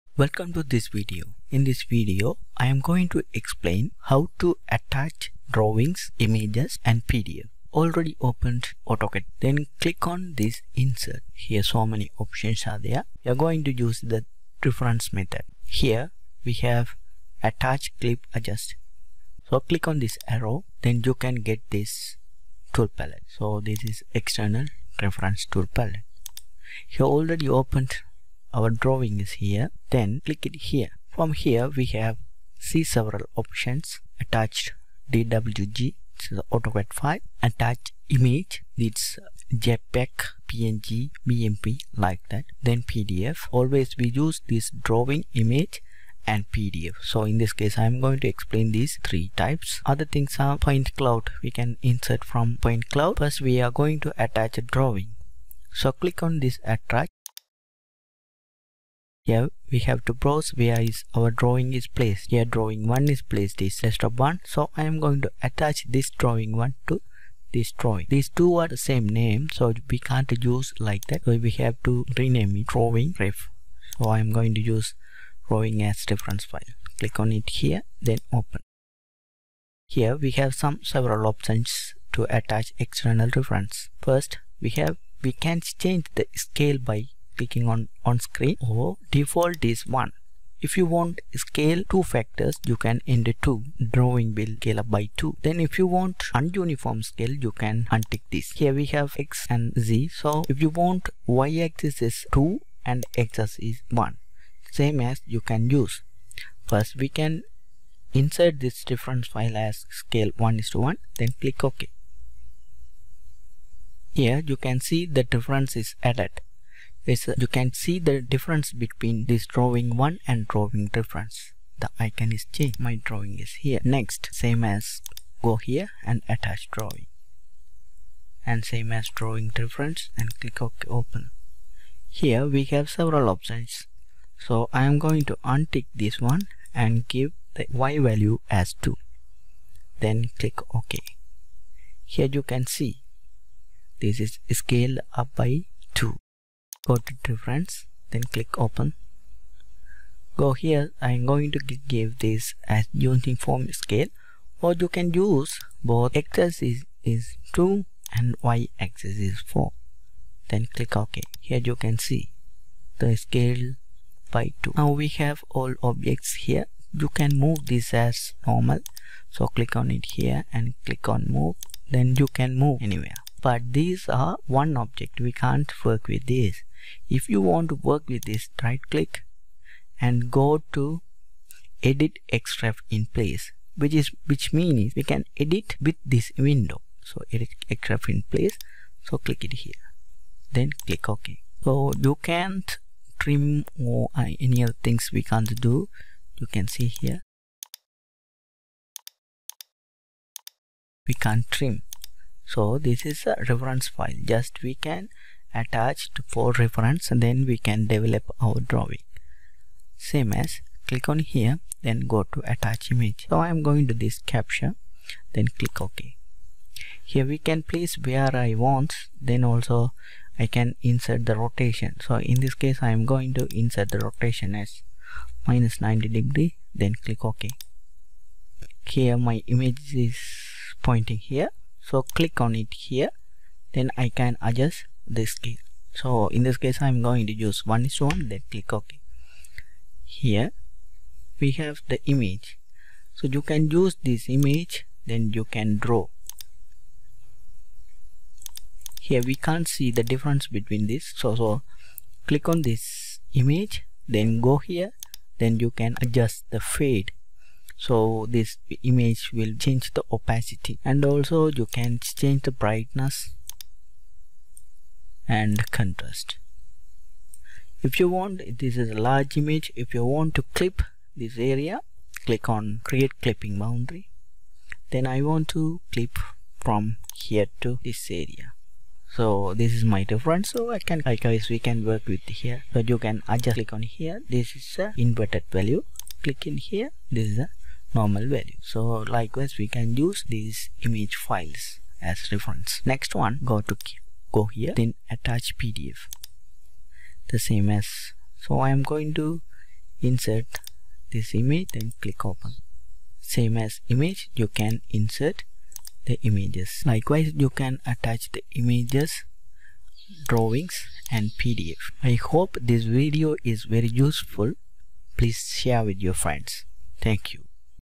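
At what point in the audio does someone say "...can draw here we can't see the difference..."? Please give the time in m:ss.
4:05.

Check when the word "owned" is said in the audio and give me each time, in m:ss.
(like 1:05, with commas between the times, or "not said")
not said.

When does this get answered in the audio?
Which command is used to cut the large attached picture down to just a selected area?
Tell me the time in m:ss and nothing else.
4:32.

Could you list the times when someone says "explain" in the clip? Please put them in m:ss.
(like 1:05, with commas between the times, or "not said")
0:03, 0:48.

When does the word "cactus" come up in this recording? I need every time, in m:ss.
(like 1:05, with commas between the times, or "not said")
not said.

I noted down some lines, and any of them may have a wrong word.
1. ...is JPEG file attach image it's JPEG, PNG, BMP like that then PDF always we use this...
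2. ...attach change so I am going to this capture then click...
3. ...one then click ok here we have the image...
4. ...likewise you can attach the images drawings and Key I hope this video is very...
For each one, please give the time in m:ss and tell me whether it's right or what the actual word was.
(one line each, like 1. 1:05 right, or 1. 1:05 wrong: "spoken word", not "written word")
1. 0:36 wrong: "AutoCAD", not "JPEG"
2. 3:32 wrong: "image", not "change"
3. 3:58 right
4. 5:06 wrong: "PDF", not "Key".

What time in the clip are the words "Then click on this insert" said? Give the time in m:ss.
0:09.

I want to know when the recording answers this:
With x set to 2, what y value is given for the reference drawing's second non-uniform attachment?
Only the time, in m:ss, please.
2:39.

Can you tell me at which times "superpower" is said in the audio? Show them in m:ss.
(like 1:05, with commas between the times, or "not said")
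not said.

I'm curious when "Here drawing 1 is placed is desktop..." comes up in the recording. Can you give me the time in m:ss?
1:02.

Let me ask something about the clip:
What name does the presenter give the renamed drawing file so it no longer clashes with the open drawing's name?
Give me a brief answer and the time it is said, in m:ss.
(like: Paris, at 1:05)
drawing ref, at 1:12.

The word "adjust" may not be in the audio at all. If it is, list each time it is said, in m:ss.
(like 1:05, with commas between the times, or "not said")
0:18, 3:54, 4:16, 4:43.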